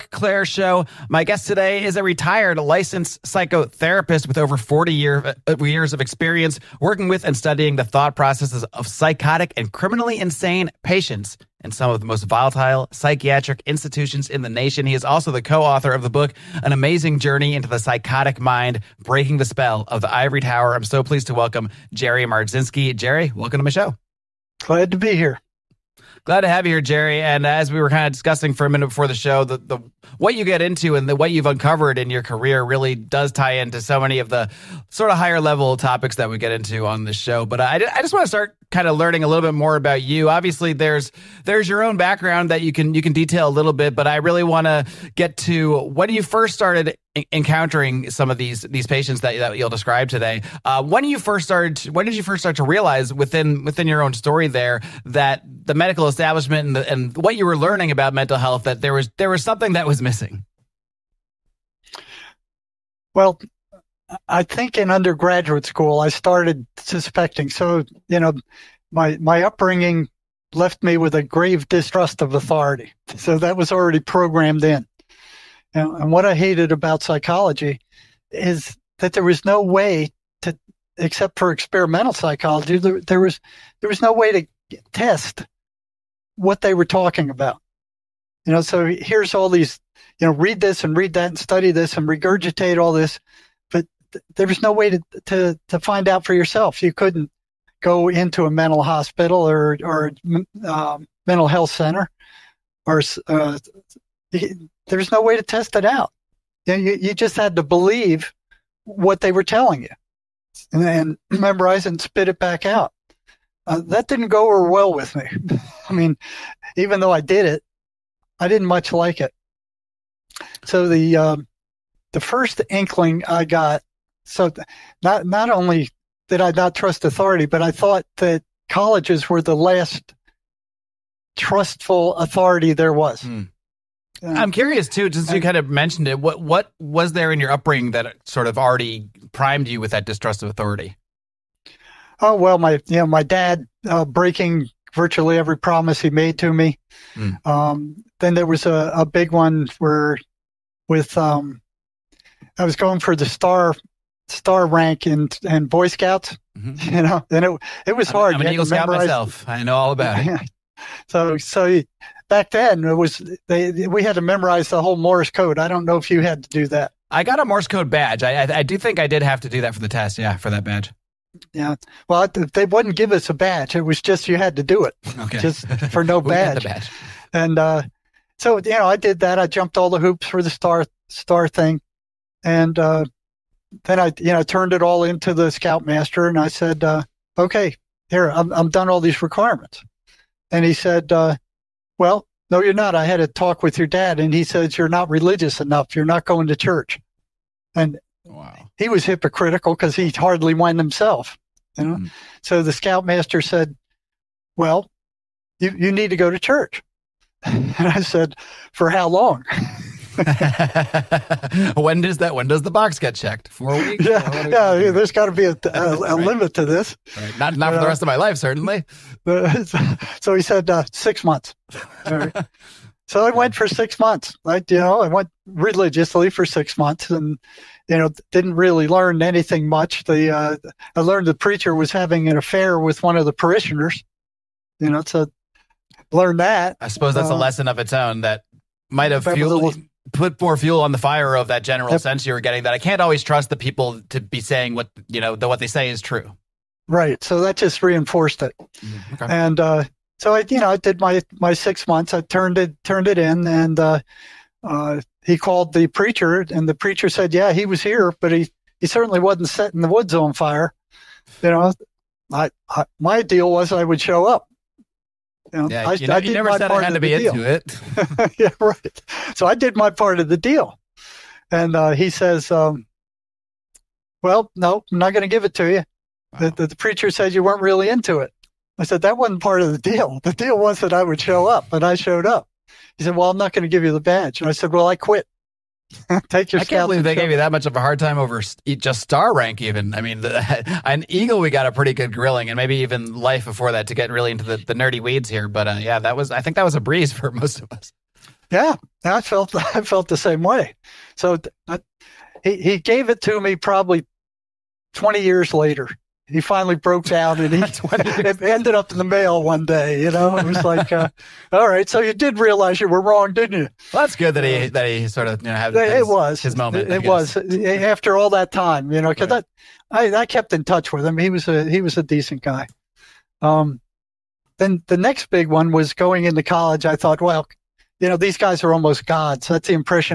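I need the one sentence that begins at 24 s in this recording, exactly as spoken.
Glad to be here glad to have you here, Jerry.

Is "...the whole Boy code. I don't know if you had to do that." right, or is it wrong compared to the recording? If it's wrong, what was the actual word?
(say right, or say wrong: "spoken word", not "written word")
wrong: "Morse", not "Boy".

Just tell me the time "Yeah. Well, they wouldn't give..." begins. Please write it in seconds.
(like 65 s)
171 s.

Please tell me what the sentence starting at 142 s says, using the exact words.
Oh well, my you know my dad uh, breaking virtually every promise he made to me.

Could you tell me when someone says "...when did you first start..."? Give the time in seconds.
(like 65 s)
51 s.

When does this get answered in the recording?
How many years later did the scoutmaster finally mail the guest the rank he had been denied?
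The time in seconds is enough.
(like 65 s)
304 s.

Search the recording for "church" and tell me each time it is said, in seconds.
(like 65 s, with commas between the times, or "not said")
196 s, 206 s.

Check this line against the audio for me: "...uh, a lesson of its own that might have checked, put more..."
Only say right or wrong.
wrong.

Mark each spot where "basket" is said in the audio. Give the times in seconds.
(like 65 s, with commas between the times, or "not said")
not said.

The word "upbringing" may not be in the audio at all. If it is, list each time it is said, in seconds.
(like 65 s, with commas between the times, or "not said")
69 s, 137 s.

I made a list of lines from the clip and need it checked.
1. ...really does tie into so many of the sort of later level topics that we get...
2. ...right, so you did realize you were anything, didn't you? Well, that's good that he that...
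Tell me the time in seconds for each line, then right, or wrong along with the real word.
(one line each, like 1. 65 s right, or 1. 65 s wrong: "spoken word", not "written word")
1. 32 s wrong: "higher", not "later"
2. 311 s wrong: "wrong", not "anything".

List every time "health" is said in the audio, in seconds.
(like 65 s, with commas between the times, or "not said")
58 s, 101 s.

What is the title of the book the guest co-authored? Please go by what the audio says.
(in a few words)
An Amazing Journey into the Psychotic Mind.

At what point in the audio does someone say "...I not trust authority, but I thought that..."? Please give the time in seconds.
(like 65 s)
126 s.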